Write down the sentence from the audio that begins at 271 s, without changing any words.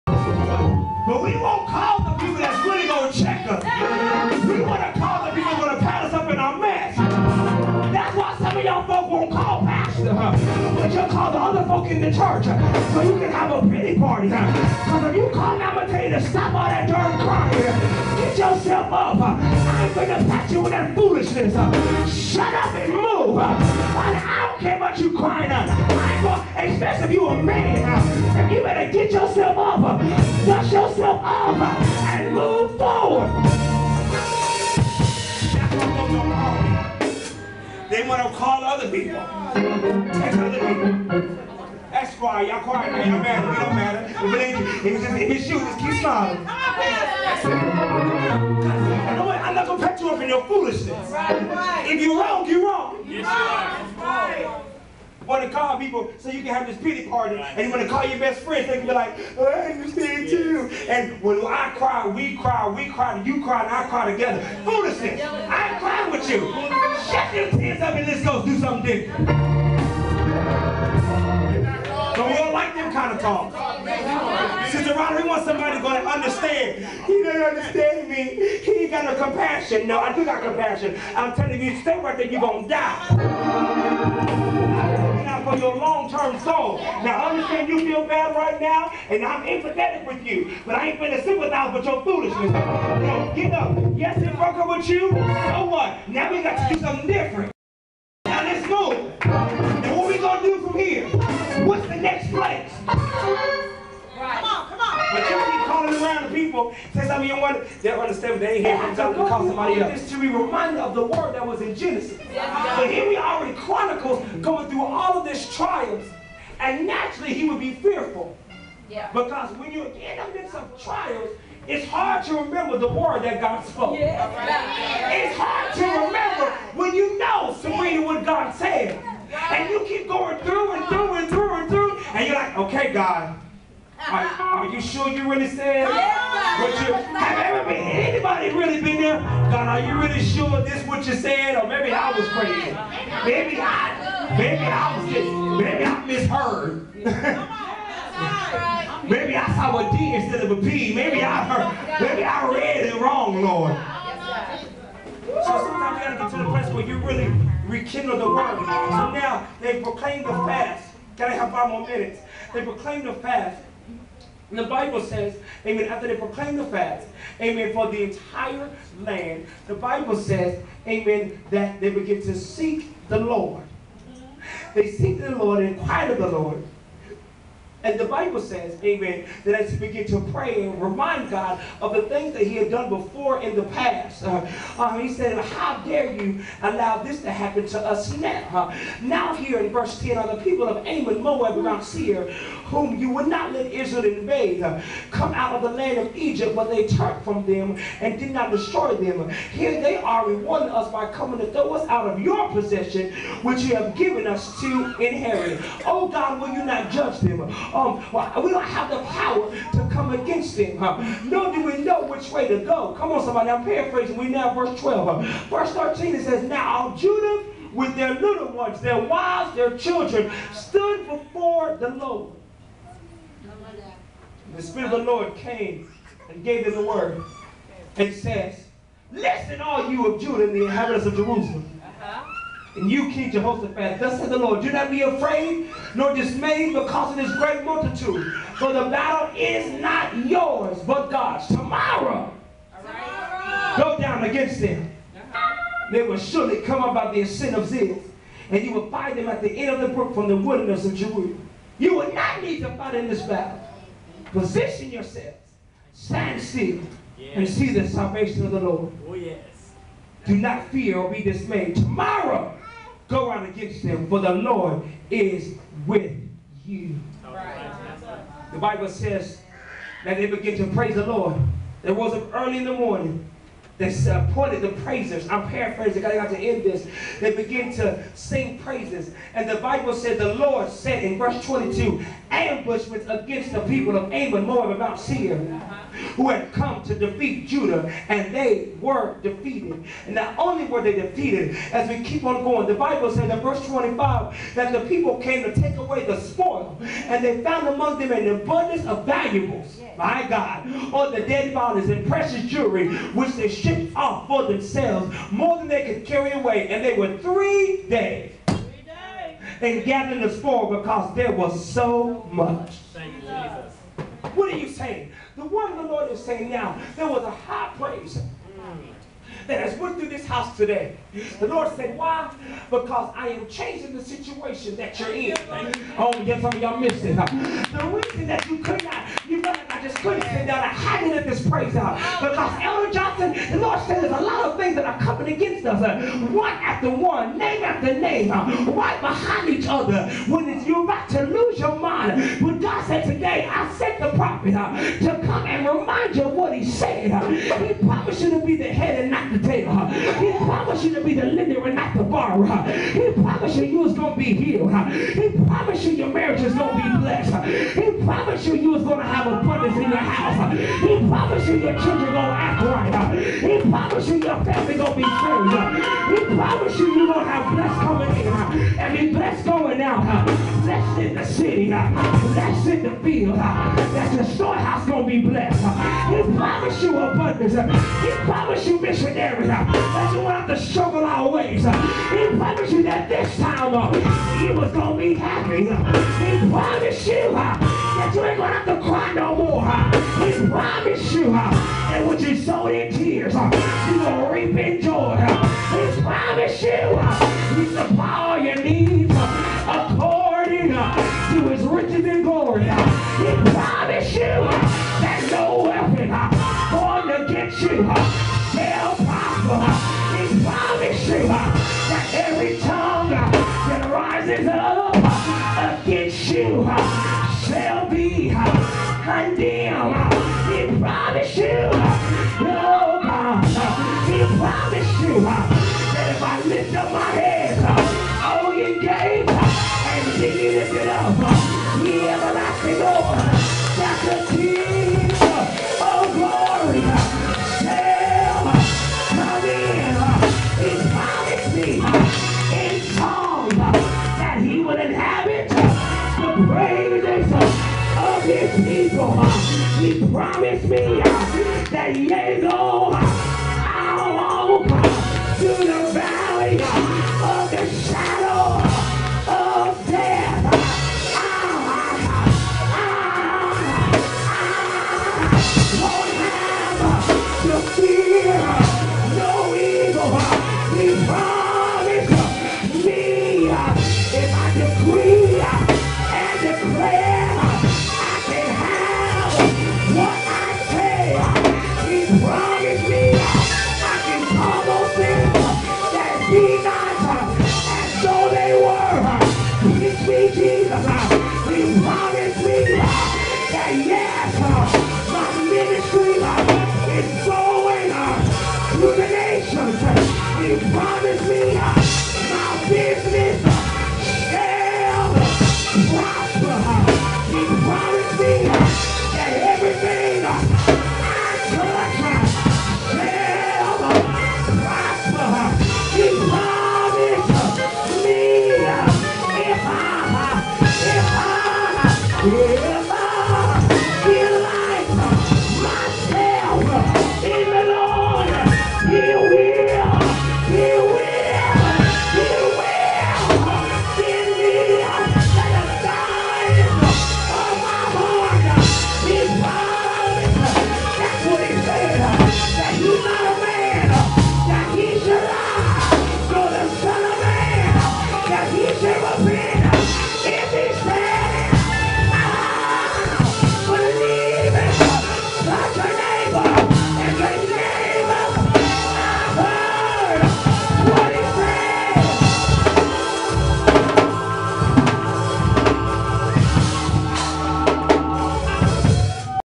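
They rose up early in the morning they appointed the uh, praisers.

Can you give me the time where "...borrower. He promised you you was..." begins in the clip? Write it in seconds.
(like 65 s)
352 s.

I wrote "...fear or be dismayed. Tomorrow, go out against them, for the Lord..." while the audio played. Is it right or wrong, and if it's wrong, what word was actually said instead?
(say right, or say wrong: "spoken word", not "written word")
right.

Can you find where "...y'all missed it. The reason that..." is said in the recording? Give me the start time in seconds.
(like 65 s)
326 s.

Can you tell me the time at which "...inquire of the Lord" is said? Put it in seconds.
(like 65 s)
175 s.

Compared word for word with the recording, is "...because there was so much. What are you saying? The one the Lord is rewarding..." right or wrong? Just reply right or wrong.
wrong.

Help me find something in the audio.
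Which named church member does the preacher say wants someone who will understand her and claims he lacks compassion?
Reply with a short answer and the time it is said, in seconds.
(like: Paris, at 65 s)
Sister Roderick, at 74 s.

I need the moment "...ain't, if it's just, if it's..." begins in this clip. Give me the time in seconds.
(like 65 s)
44 s.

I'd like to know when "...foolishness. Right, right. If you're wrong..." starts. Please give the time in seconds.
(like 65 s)
50 s.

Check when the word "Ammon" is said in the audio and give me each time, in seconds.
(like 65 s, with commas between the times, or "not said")
190 s, 284 s.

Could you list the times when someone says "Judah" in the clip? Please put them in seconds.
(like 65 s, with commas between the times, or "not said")
216 s, 230 s, 287 s.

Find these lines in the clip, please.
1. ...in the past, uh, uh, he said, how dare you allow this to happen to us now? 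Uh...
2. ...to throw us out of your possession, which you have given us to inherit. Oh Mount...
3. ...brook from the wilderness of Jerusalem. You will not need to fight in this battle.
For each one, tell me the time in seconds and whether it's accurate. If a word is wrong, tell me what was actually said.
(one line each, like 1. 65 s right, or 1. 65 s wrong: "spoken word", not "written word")
1. 183 s right
2. 201 s wrong: "God", not "Mount"
3. 249 s right.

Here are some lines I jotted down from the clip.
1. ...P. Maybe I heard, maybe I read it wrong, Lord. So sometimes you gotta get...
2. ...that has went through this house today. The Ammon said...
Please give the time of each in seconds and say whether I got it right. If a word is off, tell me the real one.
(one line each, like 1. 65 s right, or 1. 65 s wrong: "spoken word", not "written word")
1. 150 s right
2. 319 s wrong: "Lord", not "Ammon".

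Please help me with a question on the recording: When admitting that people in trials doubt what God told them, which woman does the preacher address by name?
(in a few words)
Sabrina.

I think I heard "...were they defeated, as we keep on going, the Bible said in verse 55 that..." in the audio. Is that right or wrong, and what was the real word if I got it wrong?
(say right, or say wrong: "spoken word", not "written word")
wrong: "25", not "55".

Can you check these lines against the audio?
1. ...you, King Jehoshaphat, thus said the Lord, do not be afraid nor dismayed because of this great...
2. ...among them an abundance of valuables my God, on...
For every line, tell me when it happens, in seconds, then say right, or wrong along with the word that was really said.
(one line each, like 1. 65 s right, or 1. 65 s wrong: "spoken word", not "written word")
1. 232 s right
2. 297 s right.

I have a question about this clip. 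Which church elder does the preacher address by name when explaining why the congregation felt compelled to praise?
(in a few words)
Elder Johnson.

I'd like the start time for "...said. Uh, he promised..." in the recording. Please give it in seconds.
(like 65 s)
346 s.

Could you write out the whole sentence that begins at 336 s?
One after one, name after name, uh, right behind each other.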